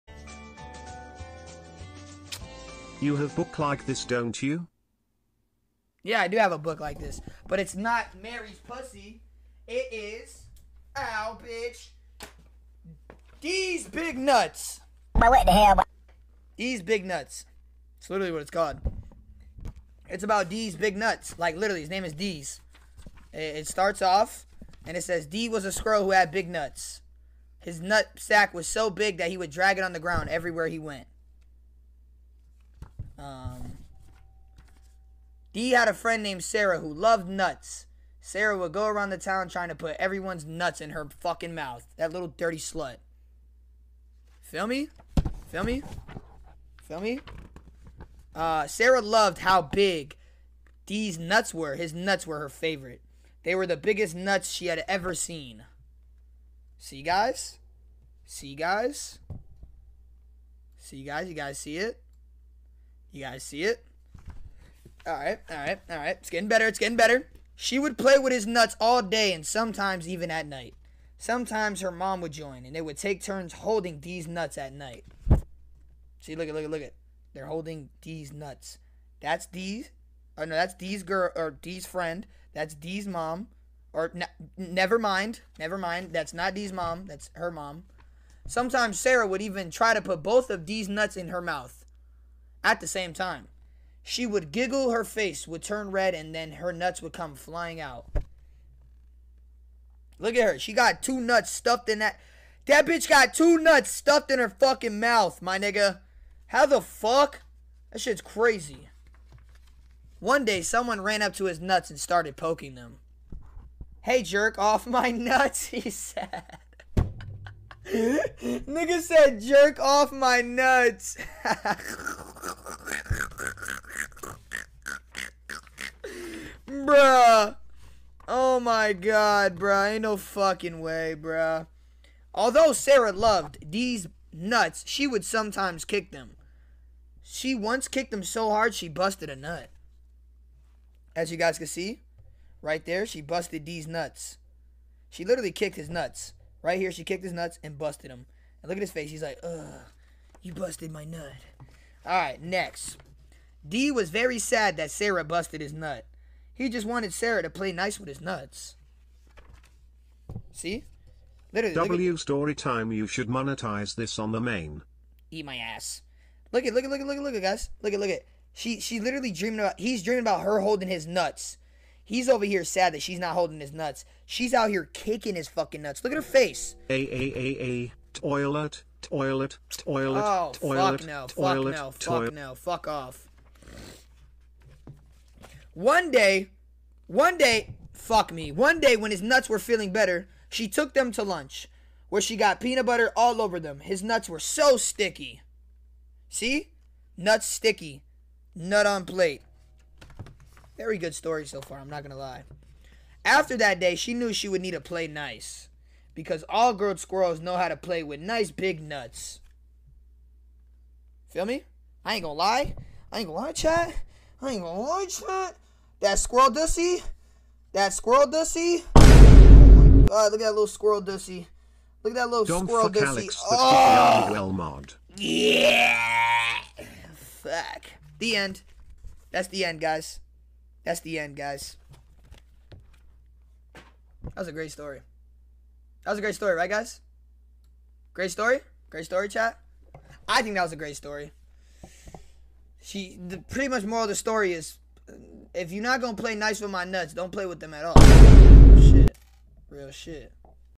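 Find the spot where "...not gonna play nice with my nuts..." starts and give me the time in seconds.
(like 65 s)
245 s.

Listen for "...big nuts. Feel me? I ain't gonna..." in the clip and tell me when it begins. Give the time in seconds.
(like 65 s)
208 s.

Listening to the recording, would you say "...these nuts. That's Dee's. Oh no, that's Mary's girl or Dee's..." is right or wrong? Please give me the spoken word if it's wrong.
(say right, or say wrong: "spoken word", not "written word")
wrong: "Dee", not "Mary".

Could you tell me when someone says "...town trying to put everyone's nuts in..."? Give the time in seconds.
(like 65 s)
39 s.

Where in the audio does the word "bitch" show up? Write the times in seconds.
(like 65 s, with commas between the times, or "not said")
11 s, 102 s.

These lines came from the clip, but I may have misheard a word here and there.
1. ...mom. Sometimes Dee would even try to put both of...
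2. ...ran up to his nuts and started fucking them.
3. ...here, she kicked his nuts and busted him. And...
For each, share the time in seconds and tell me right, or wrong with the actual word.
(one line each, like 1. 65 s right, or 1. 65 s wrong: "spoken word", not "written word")
1. 87 s wrong: "Sarah", not "Dee"
2. 111 s wrong: "poking", not "fucking"
3. 146 s right.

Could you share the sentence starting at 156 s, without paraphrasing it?
He just wanted Sarah to play nice with his nuts.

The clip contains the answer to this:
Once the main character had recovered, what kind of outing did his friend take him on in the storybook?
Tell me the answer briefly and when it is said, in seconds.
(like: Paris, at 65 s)
Lunch, at 191 s.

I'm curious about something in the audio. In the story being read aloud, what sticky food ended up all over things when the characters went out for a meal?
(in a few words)
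Peanut butter.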